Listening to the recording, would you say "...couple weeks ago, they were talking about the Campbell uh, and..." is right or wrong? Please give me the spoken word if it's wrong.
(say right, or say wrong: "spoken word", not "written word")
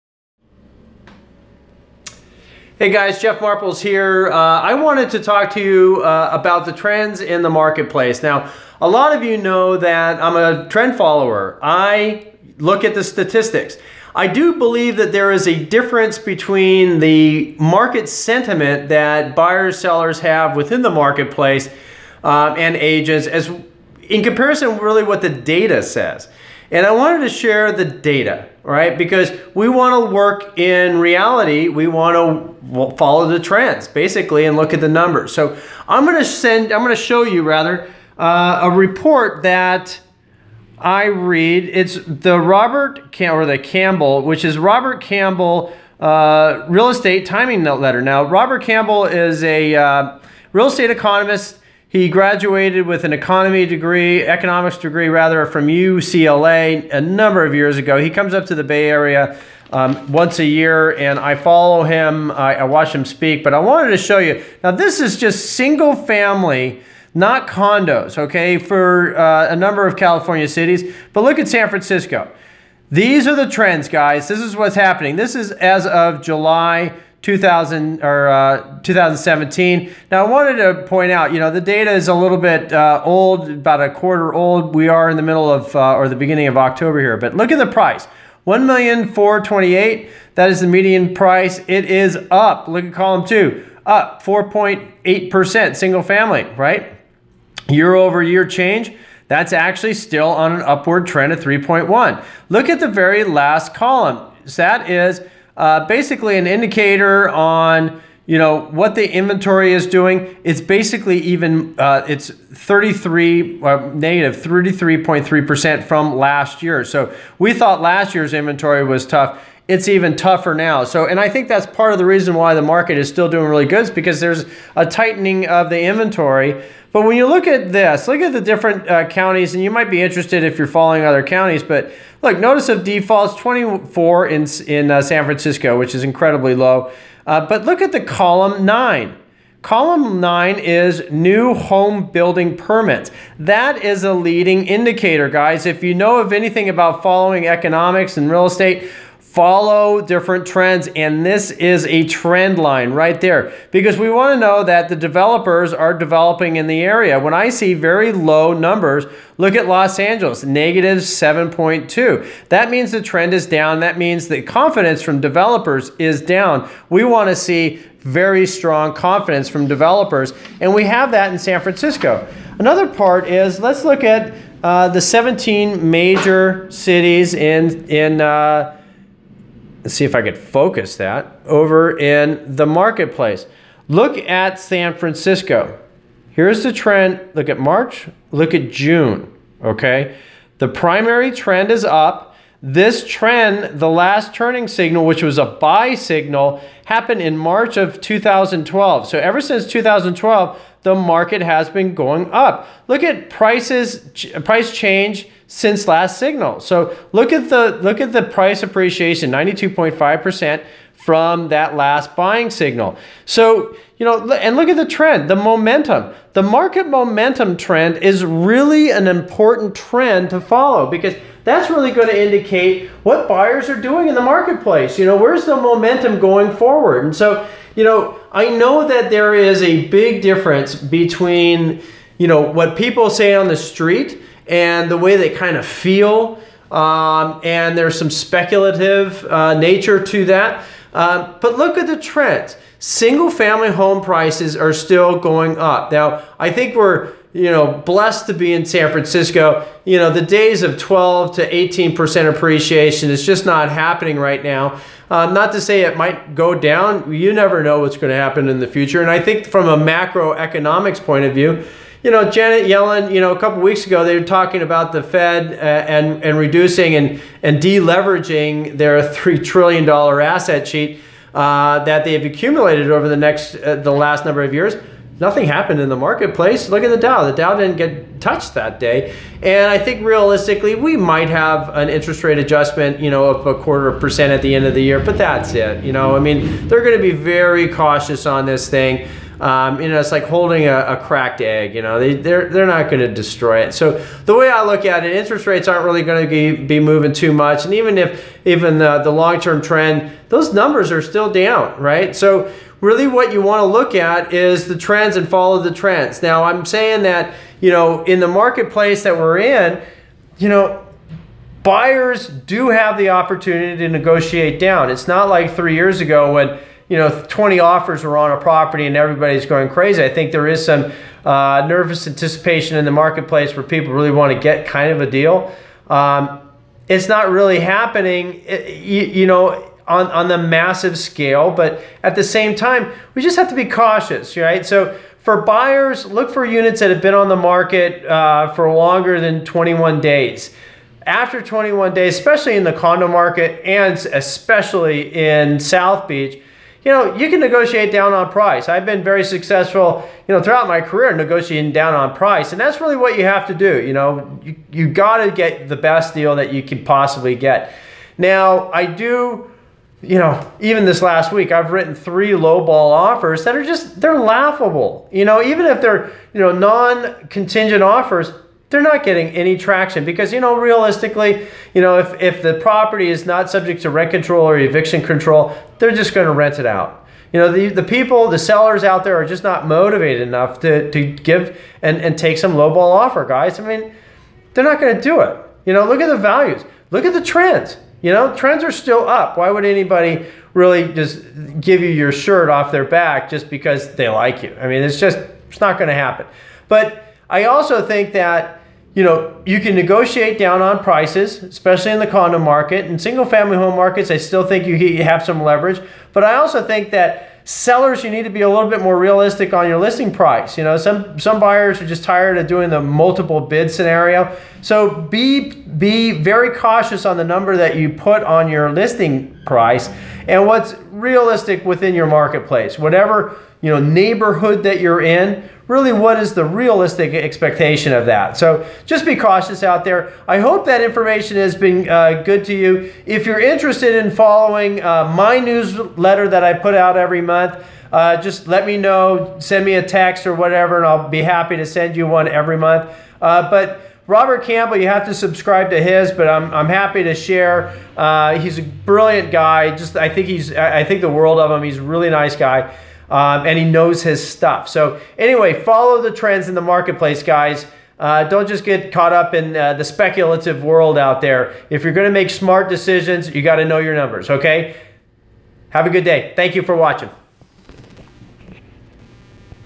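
wrong: "Fed", not "Campbell".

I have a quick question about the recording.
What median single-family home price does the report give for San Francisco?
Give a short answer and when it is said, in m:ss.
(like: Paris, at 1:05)
1,428, at 1:28.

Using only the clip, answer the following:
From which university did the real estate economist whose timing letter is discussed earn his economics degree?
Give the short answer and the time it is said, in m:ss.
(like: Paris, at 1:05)
UCLA, at 0:55.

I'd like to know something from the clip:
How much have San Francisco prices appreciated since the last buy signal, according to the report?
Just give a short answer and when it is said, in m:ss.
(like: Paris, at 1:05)
92.5%, at 3:29.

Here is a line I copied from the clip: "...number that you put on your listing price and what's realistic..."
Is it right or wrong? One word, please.
right.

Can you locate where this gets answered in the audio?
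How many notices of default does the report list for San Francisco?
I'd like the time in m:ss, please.
2:13.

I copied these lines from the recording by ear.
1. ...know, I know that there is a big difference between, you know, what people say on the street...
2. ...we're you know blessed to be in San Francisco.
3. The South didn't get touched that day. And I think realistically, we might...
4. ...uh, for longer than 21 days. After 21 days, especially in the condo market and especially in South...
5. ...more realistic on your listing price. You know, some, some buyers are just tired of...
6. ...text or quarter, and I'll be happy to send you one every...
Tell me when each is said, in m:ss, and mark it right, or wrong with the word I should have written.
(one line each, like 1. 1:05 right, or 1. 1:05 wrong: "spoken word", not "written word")
1. 3:47 right
2. 4:06 right
3. 4:37 wrong: "Dow", not "South"
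4. 5:38 right
5. 6:48 right
6. 7:19 wrong: "whatever", not "quarter".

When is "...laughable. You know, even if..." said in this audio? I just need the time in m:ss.
6:04.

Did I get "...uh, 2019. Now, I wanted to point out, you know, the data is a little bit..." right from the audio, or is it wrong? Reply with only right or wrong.
wrong.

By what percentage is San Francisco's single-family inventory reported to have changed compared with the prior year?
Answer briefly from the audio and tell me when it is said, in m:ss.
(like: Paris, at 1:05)
-33.3%, at 1:53.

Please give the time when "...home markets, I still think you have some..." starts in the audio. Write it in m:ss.
6:43.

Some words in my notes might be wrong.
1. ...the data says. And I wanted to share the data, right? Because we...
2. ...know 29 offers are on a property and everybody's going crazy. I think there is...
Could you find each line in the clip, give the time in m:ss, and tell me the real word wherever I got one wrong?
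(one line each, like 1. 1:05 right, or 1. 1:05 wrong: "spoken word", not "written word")
1. 0:25 right
2. 5:16 wrong: "20", not "29".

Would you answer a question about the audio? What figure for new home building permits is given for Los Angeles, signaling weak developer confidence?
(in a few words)
-7.2.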